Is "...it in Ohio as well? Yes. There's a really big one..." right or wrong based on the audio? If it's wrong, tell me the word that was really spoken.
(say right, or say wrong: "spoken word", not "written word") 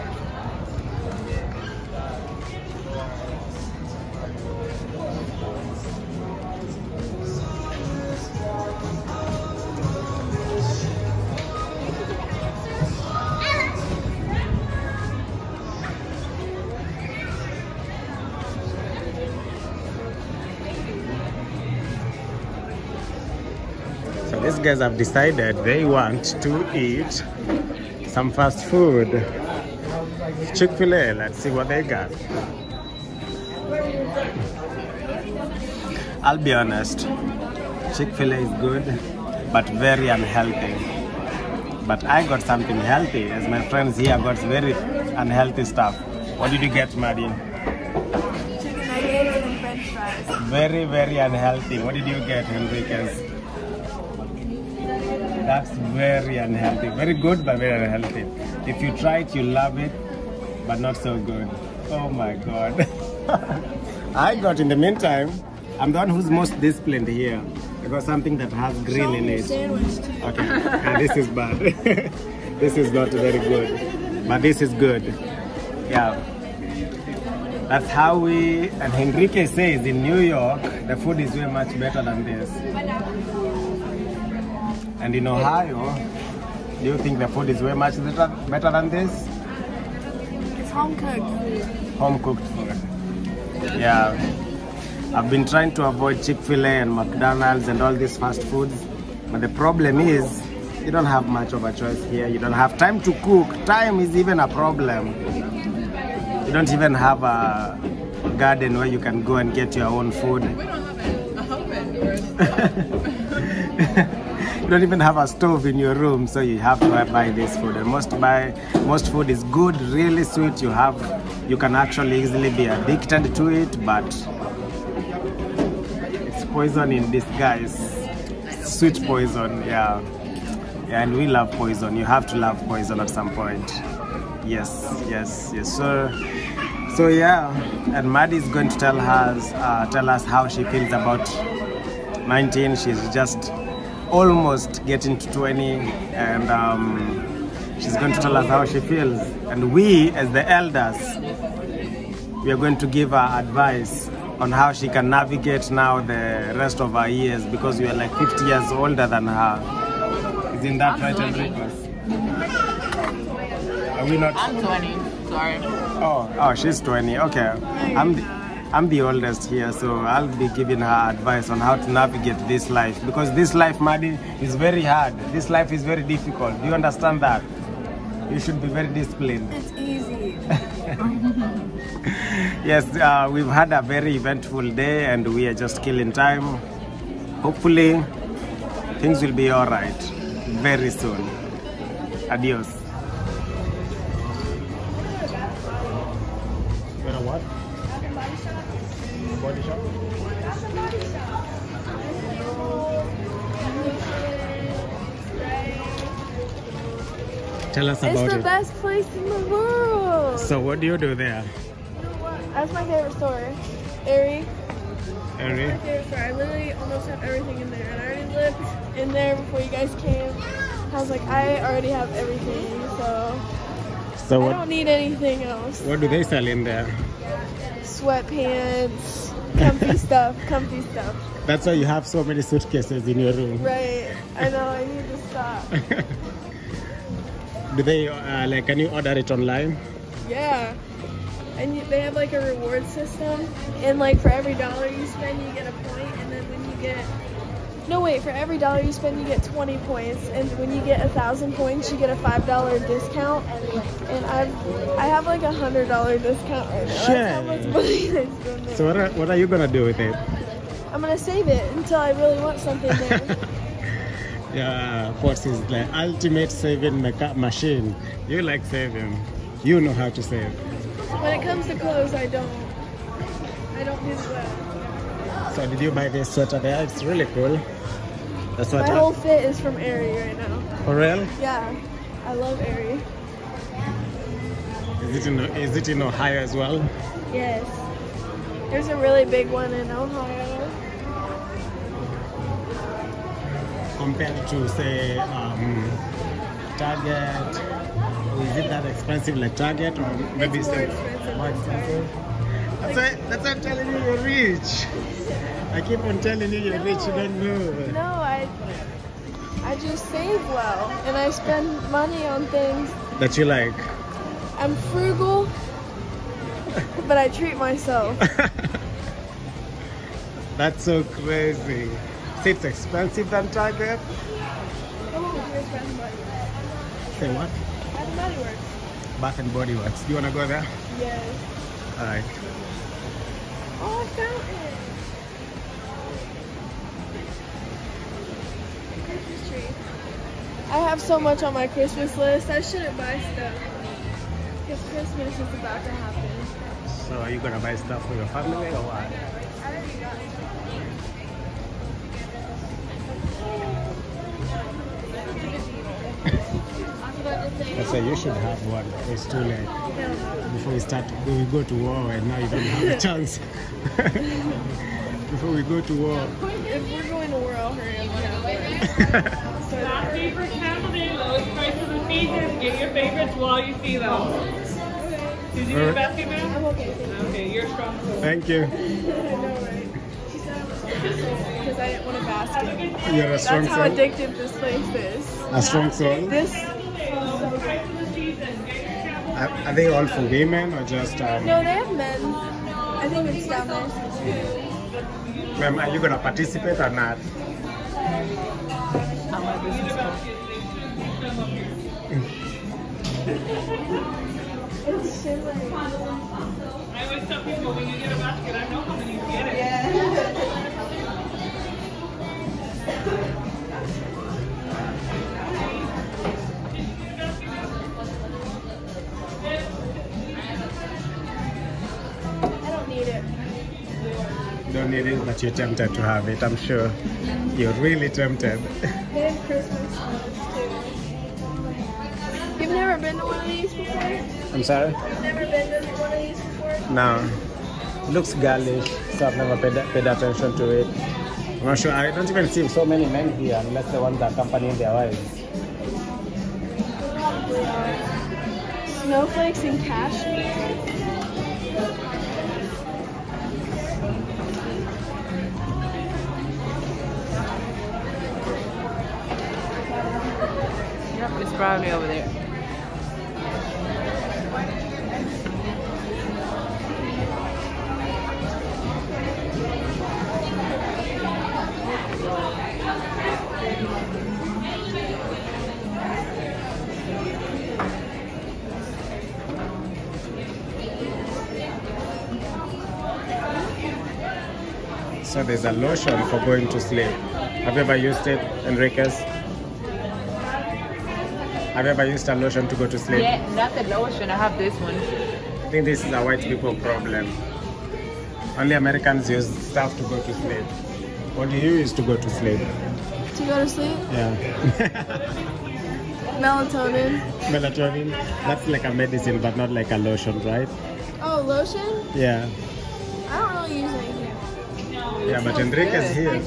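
right.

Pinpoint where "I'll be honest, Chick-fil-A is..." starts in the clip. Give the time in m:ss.
0:36.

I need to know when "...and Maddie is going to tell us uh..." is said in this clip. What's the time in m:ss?
2:17.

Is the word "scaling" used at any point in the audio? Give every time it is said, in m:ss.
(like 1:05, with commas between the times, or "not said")
not said.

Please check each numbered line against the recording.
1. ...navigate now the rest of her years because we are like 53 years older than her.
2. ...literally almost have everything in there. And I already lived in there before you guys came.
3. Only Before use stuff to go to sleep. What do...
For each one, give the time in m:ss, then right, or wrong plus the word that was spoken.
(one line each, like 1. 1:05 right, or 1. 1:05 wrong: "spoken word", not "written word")
1. 2:35 wrong: "50", not "53"
2. 3:36 right
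3. 8:18 wrong: "Americans", not "Before".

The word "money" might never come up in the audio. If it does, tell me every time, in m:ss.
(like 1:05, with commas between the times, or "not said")
4:17, 5:11.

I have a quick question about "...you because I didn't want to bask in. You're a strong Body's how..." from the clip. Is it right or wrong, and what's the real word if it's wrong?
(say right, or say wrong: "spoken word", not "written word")
wrong: "That", not "Body".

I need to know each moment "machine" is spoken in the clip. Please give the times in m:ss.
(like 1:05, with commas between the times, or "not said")
4:27.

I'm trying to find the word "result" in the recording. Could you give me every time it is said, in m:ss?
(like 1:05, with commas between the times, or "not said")
not said.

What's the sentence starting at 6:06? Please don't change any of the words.
If we're going to war, I'll hurry up.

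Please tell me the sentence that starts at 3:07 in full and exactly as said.
Hopefully, things will be all right very soon.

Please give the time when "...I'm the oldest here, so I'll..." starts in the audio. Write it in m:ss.
2:48.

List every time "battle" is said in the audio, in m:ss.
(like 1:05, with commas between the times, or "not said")
not said.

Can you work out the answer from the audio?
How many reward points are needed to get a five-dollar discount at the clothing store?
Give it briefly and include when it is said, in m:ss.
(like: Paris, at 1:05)
1000, at 4:11.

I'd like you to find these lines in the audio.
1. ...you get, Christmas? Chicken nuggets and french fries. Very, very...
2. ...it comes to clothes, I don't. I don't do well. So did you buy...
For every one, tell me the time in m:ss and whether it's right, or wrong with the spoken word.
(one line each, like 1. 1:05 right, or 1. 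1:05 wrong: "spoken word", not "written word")
1. 0:46 wrong: "Maddie", not "Christmas"
2. 4:31 right.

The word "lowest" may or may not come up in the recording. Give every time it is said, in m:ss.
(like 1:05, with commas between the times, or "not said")
6:11.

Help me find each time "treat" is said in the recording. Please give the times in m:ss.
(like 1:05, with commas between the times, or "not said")
5:17.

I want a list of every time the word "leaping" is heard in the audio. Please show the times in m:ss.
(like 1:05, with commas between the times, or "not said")
not said.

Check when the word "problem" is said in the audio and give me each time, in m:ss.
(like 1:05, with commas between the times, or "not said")
1:39, 1:44, 8:16.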